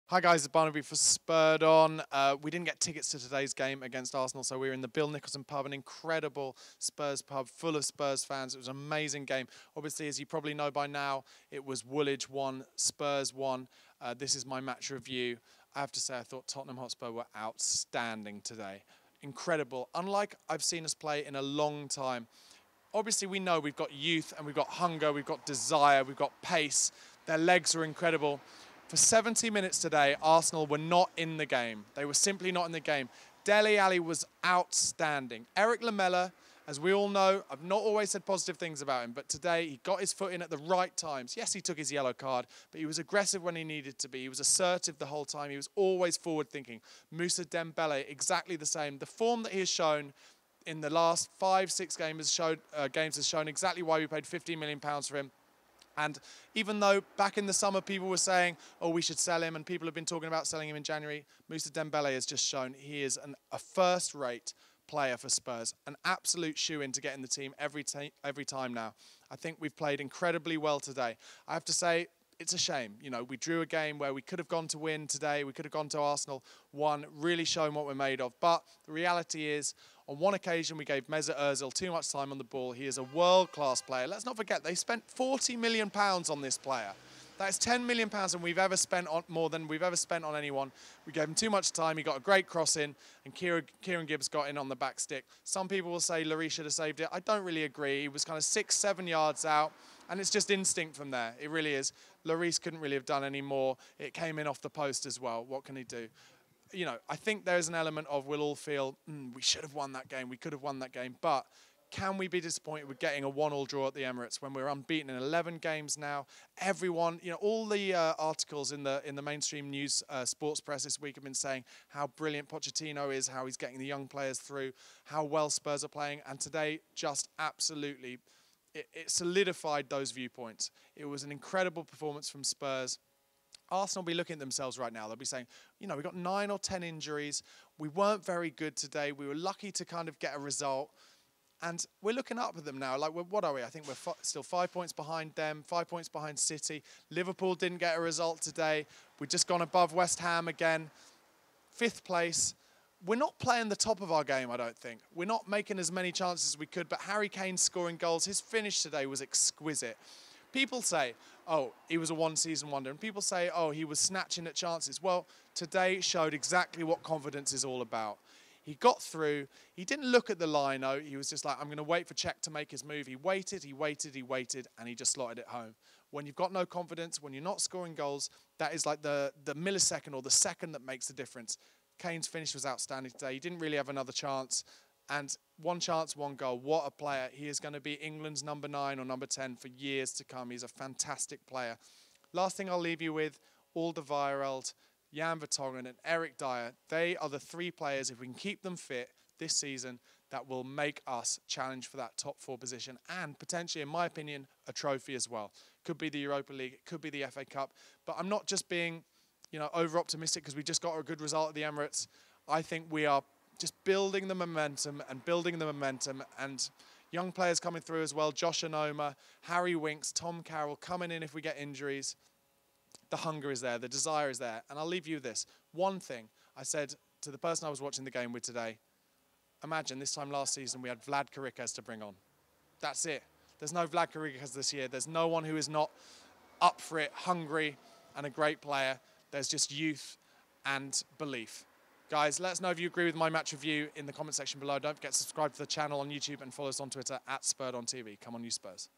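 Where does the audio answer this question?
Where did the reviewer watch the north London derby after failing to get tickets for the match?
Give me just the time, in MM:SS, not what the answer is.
00:04.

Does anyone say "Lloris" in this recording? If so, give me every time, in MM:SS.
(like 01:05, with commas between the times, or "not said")
01:36, 01:42.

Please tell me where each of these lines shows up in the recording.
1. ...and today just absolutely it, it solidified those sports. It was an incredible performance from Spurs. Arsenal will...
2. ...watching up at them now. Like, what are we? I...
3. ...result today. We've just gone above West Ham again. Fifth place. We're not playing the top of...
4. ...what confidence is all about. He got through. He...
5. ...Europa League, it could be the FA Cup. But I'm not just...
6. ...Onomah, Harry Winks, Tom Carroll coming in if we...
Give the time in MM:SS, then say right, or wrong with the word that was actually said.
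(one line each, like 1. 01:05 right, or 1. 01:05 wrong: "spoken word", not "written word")
1. 02:06 wrong: "viewpoints", not "sports"
2. 02:22 wrong: "looking", not "watching"
3. 02:28 right
4. 02:46 right
5. 03:26 right
6. 03:38 right.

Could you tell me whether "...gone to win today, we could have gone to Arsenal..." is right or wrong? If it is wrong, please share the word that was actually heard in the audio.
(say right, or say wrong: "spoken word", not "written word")
right.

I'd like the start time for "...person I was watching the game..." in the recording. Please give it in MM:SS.
03:47.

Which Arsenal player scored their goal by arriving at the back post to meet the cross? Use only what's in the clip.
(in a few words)
Kieran Gibbs.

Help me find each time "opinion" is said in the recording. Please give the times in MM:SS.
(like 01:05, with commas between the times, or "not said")
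03:24.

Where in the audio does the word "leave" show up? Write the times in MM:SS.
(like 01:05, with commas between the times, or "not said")
03:12, 03:44.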